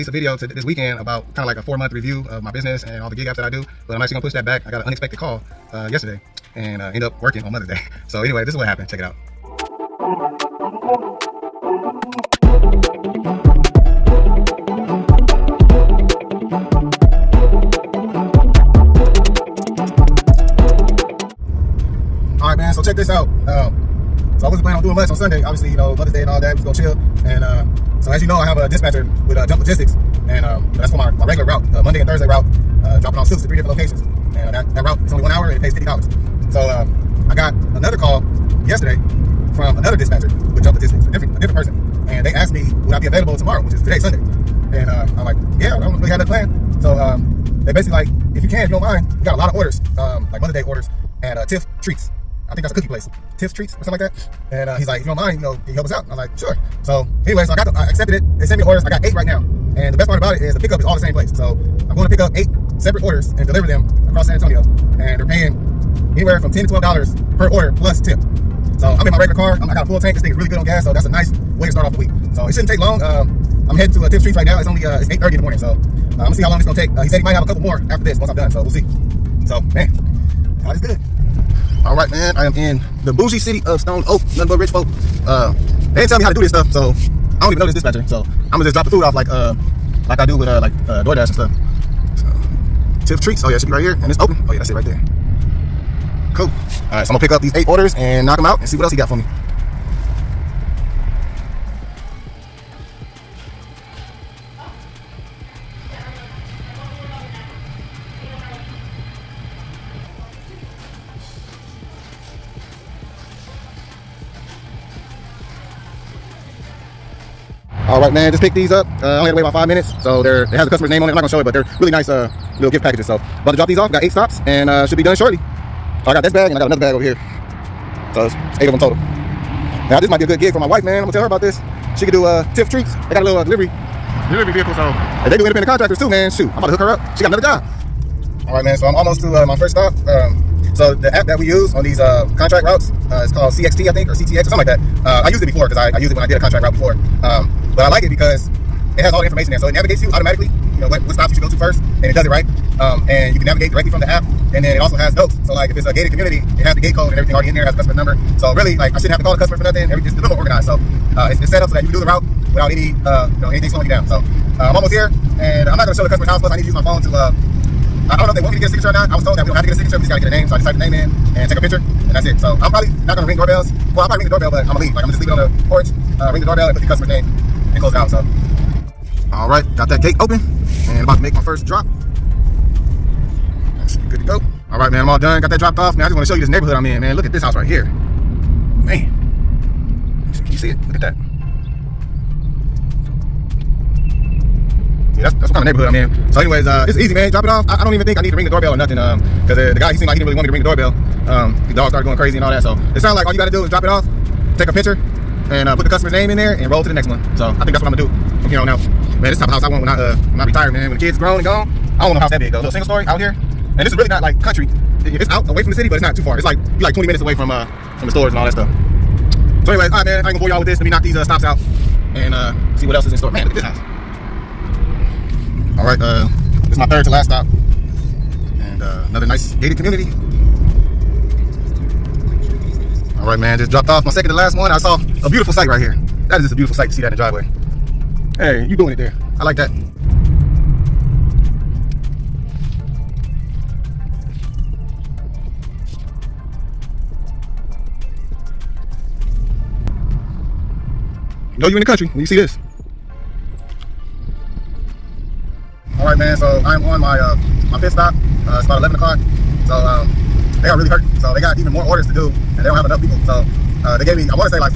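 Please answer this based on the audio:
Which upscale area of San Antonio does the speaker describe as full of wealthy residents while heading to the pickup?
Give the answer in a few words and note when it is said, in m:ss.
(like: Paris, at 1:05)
Stone Oak, at 1:23.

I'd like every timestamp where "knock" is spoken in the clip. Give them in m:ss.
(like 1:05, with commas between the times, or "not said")
1:38, 3:40.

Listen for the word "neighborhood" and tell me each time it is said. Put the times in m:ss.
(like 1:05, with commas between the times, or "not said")
3:06, 3:15.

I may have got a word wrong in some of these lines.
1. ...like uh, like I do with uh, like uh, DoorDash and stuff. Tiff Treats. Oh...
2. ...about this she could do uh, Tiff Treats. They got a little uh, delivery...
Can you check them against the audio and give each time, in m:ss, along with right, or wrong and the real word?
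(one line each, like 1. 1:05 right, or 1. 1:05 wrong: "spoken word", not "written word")
1. 1:29 right
2. 2:11 right.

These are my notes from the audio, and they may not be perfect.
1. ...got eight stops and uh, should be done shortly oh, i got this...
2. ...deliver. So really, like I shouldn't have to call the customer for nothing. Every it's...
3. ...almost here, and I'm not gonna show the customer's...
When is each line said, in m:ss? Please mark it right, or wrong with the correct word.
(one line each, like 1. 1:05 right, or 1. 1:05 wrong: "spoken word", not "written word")
1. 2:03 right
2. 2:37 wrong: "number", not "deliver"
3. 2:44 right.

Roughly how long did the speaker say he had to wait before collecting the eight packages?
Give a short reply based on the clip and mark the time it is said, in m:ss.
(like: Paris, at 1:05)
About five minutes, at 1:59.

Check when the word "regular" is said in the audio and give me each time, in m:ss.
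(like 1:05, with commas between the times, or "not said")
0:31, 1:09.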